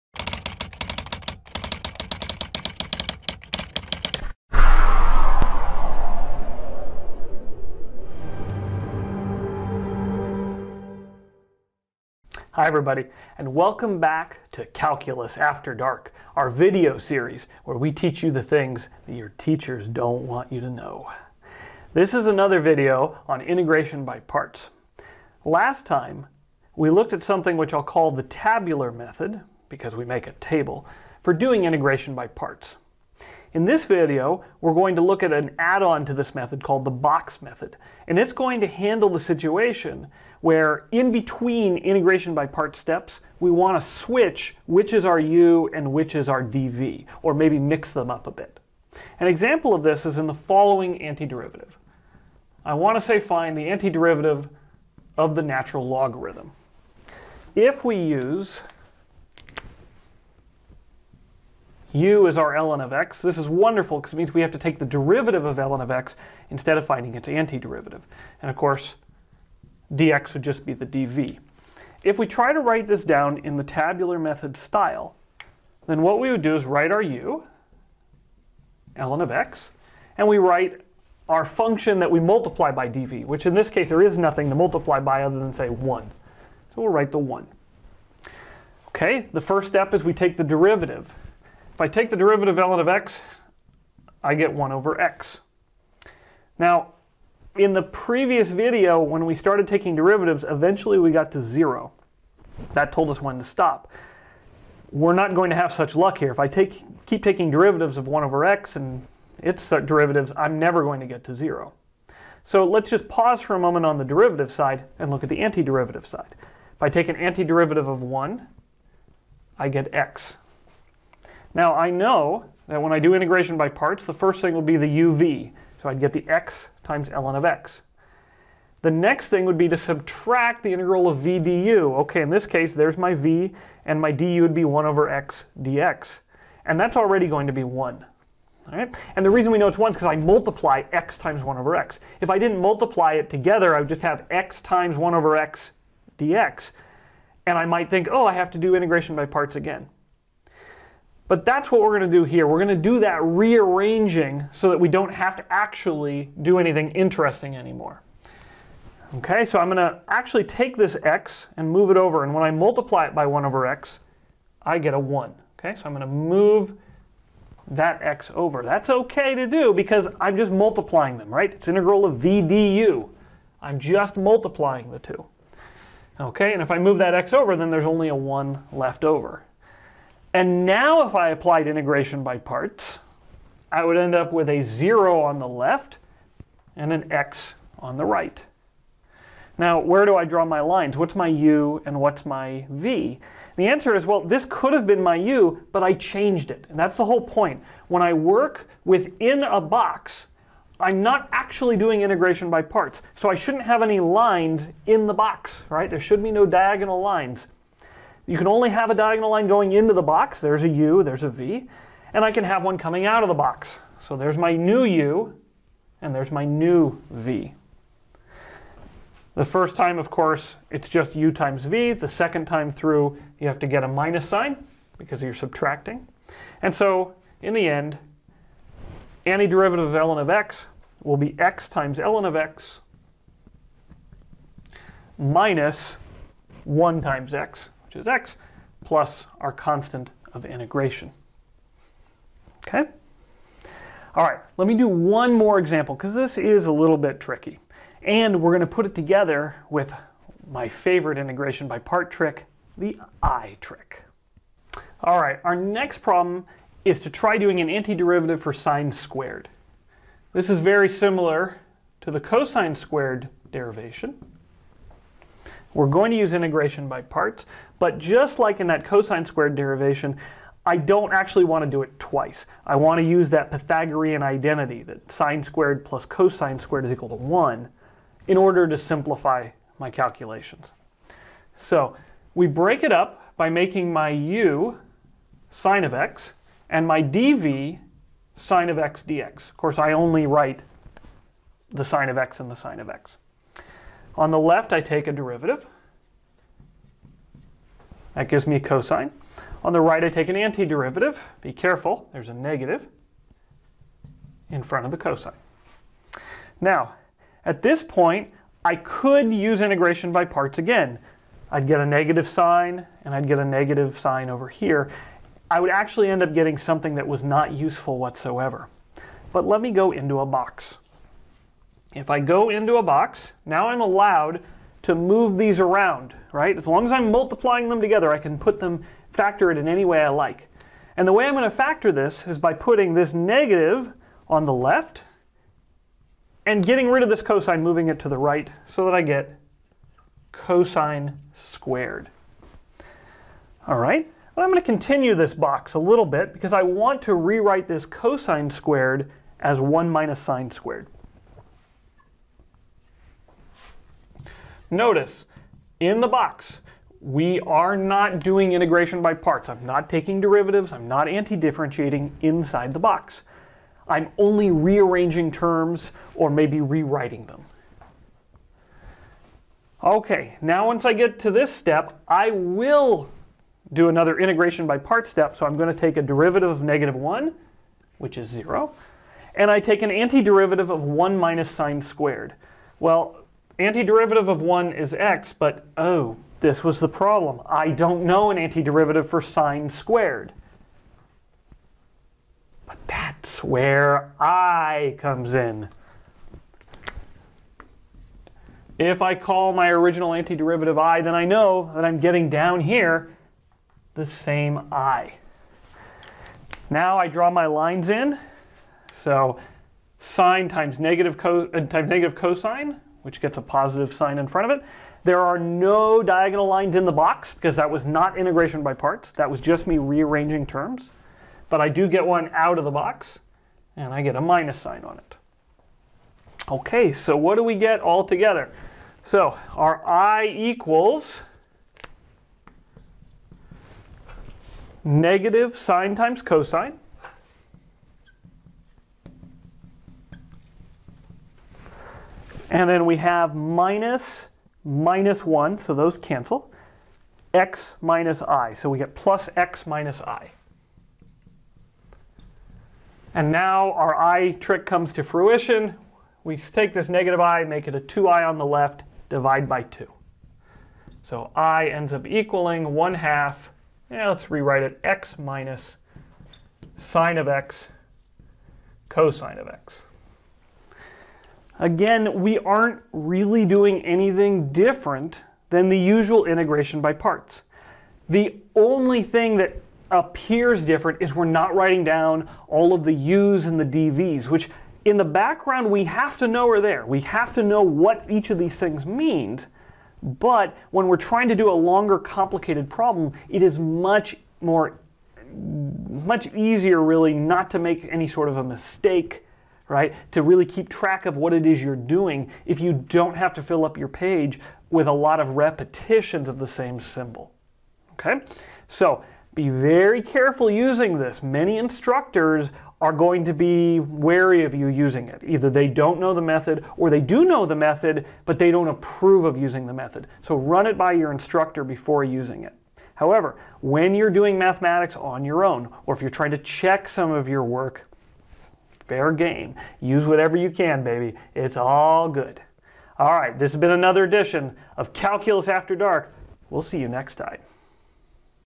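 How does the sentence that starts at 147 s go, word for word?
And I might think, oh, I have to do integration by parts again.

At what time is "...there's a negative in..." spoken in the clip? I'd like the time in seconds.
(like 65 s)
302 s.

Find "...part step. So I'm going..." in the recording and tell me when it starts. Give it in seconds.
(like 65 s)
374 s.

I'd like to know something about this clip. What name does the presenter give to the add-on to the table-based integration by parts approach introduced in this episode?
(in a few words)
box method.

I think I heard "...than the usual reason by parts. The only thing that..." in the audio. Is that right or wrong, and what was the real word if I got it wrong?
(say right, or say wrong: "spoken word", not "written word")
wrong: "integration", not "reason".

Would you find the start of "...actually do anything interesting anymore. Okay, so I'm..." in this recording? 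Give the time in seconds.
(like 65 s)
155 s.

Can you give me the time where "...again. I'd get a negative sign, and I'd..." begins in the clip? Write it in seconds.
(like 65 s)
310 s.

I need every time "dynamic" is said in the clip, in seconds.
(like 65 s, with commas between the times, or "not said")
not said.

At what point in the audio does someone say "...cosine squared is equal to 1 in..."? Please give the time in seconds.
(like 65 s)
276 s.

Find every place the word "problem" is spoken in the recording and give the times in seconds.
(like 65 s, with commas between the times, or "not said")
256 s, 386 s, 492 s.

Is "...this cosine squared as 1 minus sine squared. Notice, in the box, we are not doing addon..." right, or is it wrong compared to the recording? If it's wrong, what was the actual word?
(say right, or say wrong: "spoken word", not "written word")
wrong: "integration", not "addon".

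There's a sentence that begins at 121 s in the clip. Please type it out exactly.
Now I know that when I do integration by parts, the first thing will be the uv.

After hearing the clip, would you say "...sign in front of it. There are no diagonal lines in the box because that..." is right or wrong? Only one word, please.
right.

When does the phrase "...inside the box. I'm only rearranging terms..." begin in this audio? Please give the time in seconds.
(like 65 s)
362 s.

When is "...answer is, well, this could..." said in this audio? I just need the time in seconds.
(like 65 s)
193 s.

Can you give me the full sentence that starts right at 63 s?
This is wonderful because it means we have to take the derivative of ln of x instead of finding its antiderivative.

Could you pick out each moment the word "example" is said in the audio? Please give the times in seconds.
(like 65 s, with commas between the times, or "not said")
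49 s, 245 s.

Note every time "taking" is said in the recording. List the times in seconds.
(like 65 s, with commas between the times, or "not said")
99 s, 107 s, 359 s.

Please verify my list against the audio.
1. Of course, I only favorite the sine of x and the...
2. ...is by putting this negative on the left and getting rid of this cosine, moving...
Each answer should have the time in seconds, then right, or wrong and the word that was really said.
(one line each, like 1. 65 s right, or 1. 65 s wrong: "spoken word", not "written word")
1. 289 s wrong: "write", not "favorite"
2. 332 s right.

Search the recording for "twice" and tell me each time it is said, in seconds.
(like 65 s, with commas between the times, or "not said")
271 s.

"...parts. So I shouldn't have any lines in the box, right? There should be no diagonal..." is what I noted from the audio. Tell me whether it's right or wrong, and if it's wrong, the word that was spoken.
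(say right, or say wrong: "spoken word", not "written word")
right.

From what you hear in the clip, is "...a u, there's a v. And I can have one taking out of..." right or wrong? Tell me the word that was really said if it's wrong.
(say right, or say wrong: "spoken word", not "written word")
wrong: "coming", not "taking".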